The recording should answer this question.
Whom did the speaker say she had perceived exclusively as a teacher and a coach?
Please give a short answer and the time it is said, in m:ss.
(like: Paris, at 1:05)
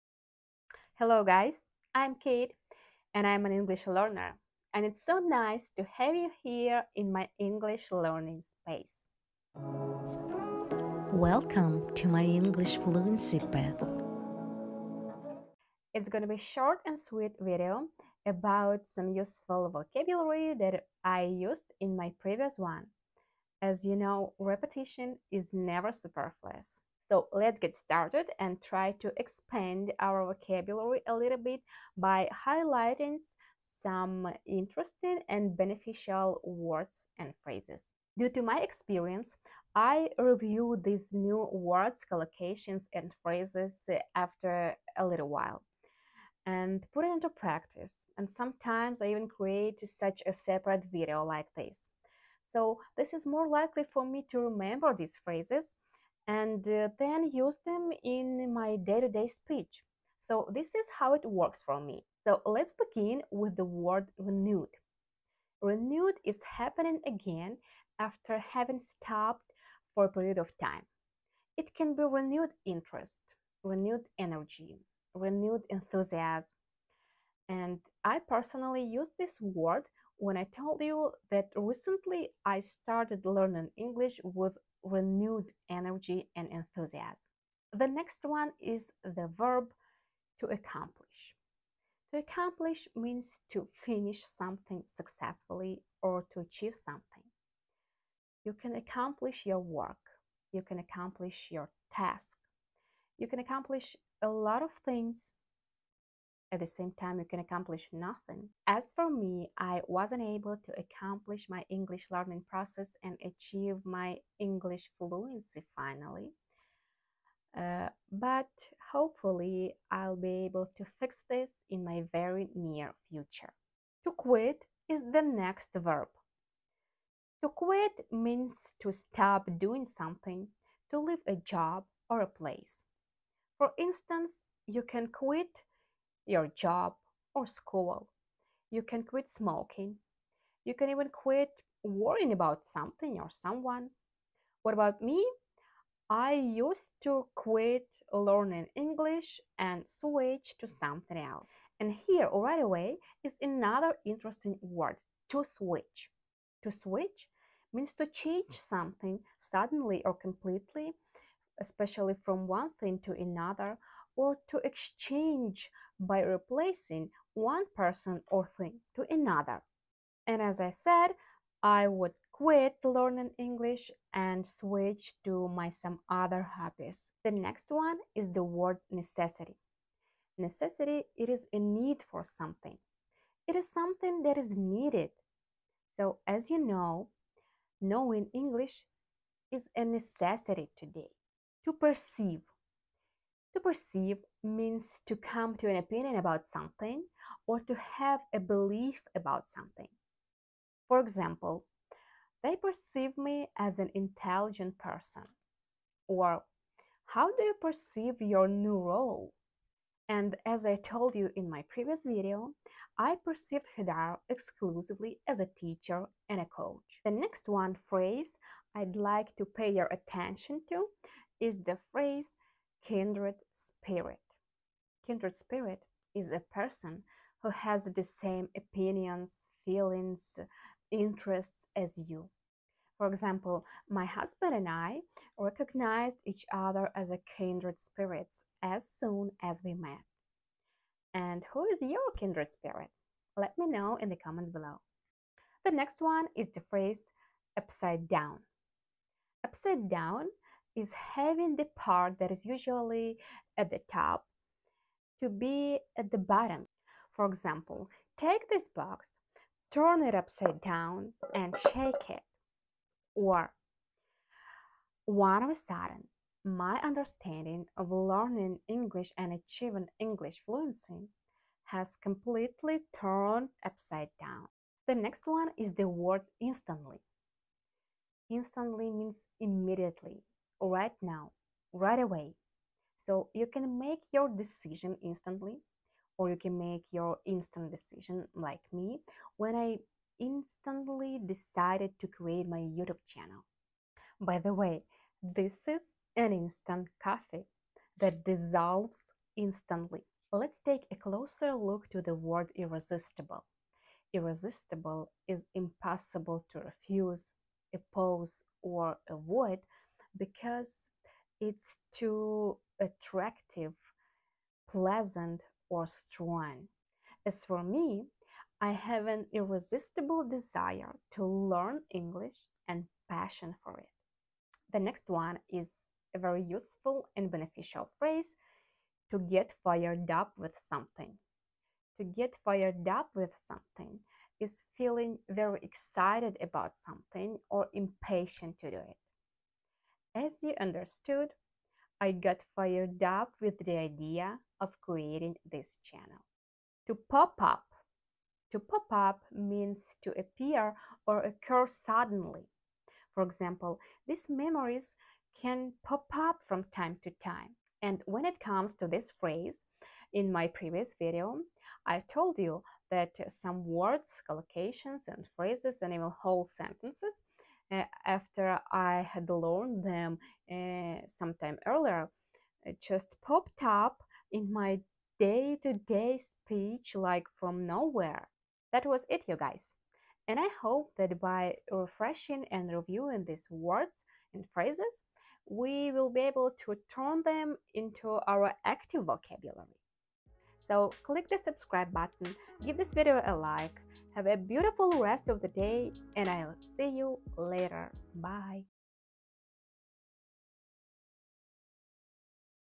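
Hadar, at 3:33.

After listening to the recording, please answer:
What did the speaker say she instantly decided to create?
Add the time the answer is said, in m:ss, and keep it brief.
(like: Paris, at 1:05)
YouTube channel, at 4:52.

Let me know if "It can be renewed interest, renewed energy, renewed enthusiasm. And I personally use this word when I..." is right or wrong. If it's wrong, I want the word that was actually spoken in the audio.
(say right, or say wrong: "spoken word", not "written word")
right.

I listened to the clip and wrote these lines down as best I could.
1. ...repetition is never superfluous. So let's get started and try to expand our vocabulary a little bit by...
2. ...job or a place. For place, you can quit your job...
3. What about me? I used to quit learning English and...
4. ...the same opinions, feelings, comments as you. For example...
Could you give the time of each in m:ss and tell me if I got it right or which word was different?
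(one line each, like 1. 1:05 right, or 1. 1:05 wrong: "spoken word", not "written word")
1. 0:24 right
2. 2:11 wrong: "instance", not "place"
3. 2:24 right
4. 3:47 wrong: "interests", not "comments".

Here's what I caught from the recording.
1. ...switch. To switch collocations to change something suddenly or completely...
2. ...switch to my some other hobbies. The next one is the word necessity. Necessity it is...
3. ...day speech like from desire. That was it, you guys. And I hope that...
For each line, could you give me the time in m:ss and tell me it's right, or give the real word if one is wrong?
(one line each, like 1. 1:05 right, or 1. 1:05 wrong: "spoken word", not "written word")
1. 2:35 wrong: "means", not "collocations"
2. 2:54 right
3. 6:15 wrong: "nowhere", not "desire".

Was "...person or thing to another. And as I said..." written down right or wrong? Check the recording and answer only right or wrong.
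right.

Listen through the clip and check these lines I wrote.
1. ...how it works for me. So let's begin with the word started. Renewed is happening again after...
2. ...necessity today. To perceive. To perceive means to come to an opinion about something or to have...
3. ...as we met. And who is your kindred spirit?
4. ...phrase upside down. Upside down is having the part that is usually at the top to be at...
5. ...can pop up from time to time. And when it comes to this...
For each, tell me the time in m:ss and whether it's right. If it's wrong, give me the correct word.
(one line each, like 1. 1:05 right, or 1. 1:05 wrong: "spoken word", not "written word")
1. 1:00 wrong: "renewed", not "started"
2. 3:09 right
3. 3:59 right
4. 4:06 right
5. 5:55 right.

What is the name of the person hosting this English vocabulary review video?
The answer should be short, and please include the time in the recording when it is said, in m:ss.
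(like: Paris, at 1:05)
Kate, at 0:02.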